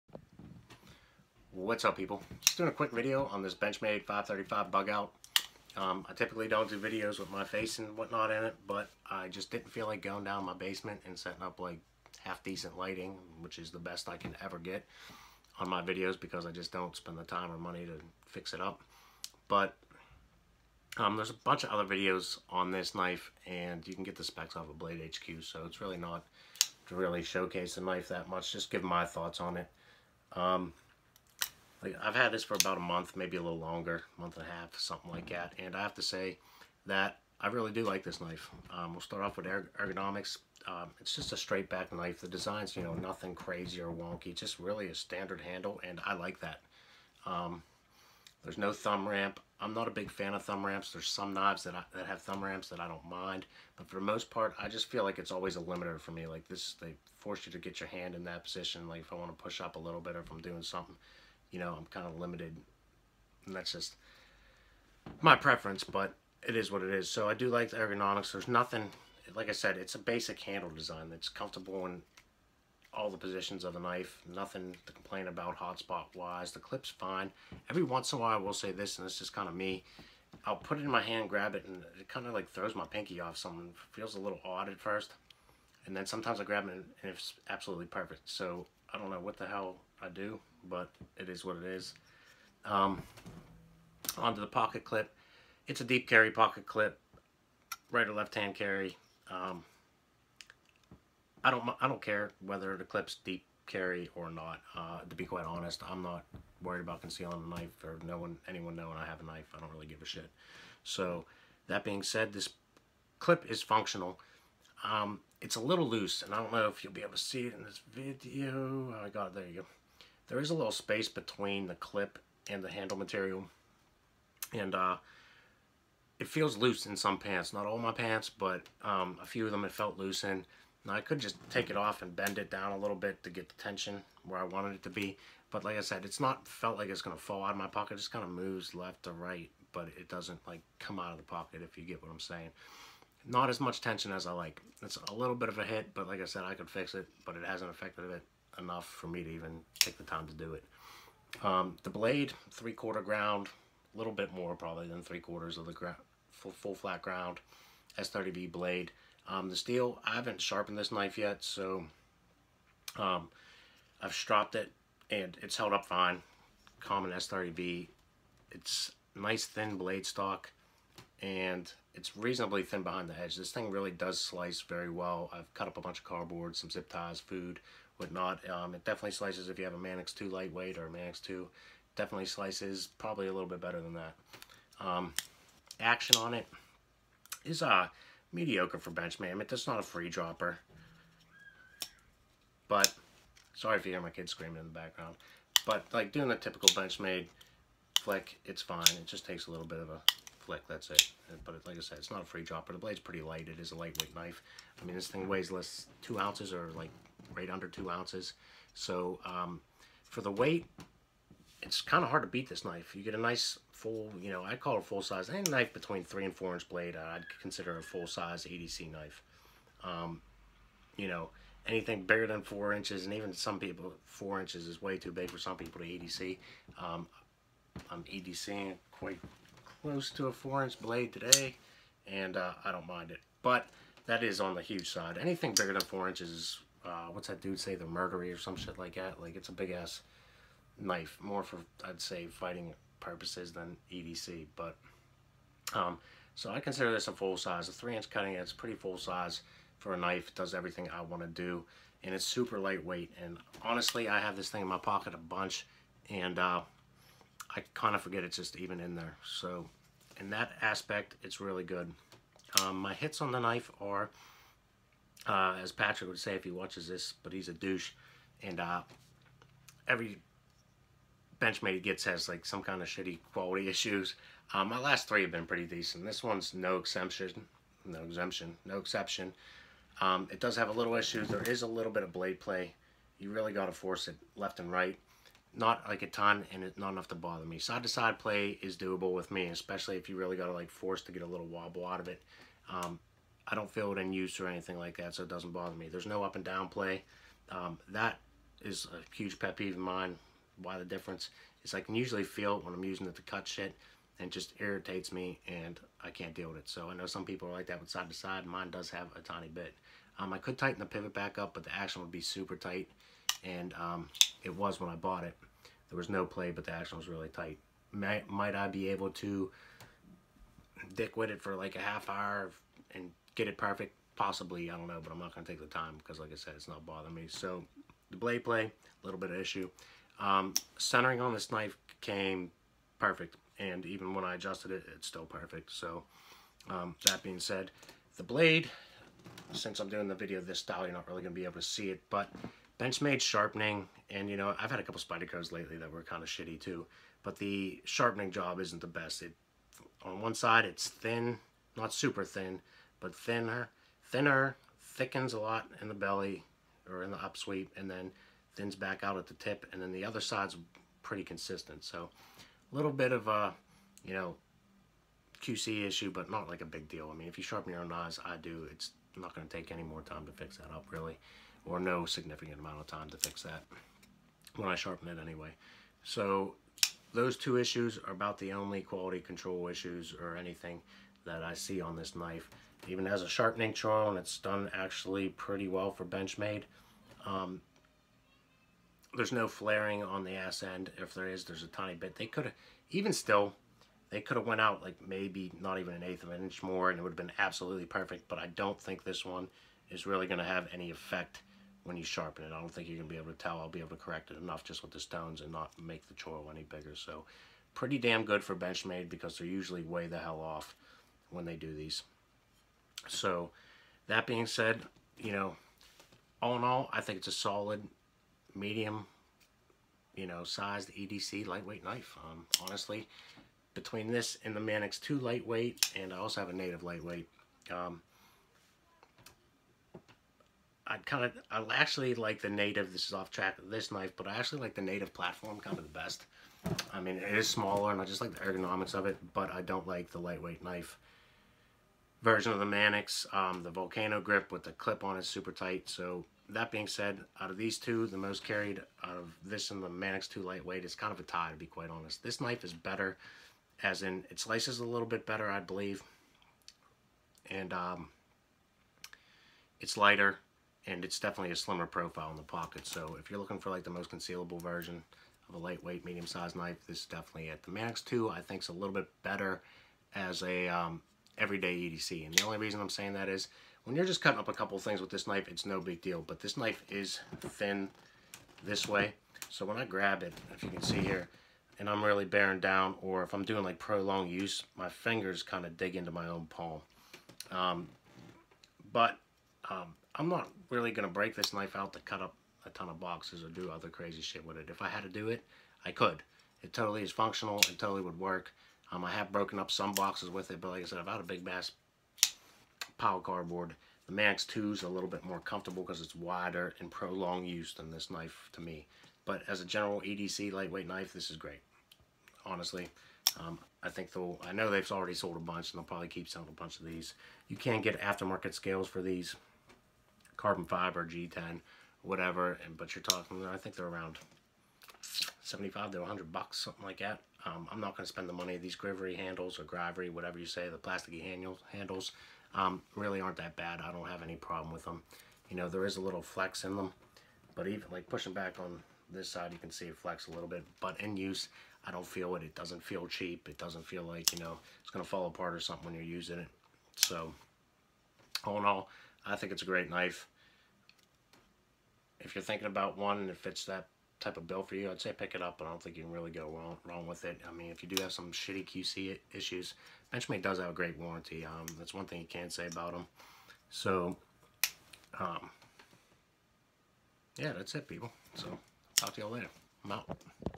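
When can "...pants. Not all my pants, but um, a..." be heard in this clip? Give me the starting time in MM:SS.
02:07.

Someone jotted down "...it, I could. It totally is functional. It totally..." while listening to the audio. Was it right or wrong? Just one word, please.
right.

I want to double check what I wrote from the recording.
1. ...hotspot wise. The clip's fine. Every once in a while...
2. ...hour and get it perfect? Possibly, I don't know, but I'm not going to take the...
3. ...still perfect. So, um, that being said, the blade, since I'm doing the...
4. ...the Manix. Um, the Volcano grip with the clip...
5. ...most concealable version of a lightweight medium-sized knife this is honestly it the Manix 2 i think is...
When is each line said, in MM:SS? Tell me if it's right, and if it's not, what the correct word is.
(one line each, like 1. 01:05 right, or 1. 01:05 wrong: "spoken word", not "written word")
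1. 01:15 right
2. 05:22 right
3. 05:35 right
4. 07:22 right
5. 07:43 wrong: "definitely", not "honestly".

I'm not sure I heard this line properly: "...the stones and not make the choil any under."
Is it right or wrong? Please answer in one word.
wrong.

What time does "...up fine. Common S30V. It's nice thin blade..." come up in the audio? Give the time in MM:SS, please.
02:45.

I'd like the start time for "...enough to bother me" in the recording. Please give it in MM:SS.
04:46.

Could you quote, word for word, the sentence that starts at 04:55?
There's no up and down play.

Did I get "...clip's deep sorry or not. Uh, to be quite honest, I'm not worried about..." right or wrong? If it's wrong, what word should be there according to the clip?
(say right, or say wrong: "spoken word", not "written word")
wrong: "carry", not "sorry".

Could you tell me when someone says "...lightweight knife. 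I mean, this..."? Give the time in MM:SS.
03:23.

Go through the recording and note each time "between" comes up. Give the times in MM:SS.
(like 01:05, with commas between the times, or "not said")
02:01, 03:35, 07:03.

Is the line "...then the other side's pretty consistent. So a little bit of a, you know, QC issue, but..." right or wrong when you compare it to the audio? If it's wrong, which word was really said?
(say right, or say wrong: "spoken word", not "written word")
right.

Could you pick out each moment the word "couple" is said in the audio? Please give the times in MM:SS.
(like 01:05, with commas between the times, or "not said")
05:44, 07:54.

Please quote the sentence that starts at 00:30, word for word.
Um, like I've had this for about a month, maybe a little longer, month and a half, something like mm-hmm.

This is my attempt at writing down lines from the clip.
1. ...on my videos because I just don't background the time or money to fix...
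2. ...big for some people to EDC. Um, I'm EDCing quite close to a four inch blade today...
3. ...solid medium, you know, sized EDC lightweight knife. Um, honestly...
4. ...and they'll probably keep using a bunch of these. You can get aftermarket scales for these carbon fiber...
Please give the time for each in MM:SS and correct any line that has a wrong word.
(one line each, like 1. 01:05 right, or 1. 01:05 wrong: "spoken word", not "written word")
1. 00:15 wrong: "spend", not "background"
2. 03:45 right
3. 06:57 right
4. 08:35 wrong: "selling", not "using".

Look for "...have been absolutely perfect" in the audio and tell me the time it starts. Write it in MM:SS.
06:37.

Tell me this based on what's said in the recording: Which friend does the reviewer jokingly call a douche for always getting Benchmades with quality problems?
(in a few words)
Patrick.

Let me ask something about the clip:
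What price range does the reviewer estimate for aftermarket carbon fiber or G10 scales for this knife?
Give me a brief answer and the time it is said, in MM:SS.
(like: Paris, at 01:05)
$75 to $100, at 08:45.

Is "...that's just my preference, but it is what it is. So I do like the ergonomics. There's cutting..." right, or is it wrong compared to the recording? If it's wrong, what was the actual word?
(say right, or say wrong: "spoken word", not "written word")
wrong: "nothing", not "cutting".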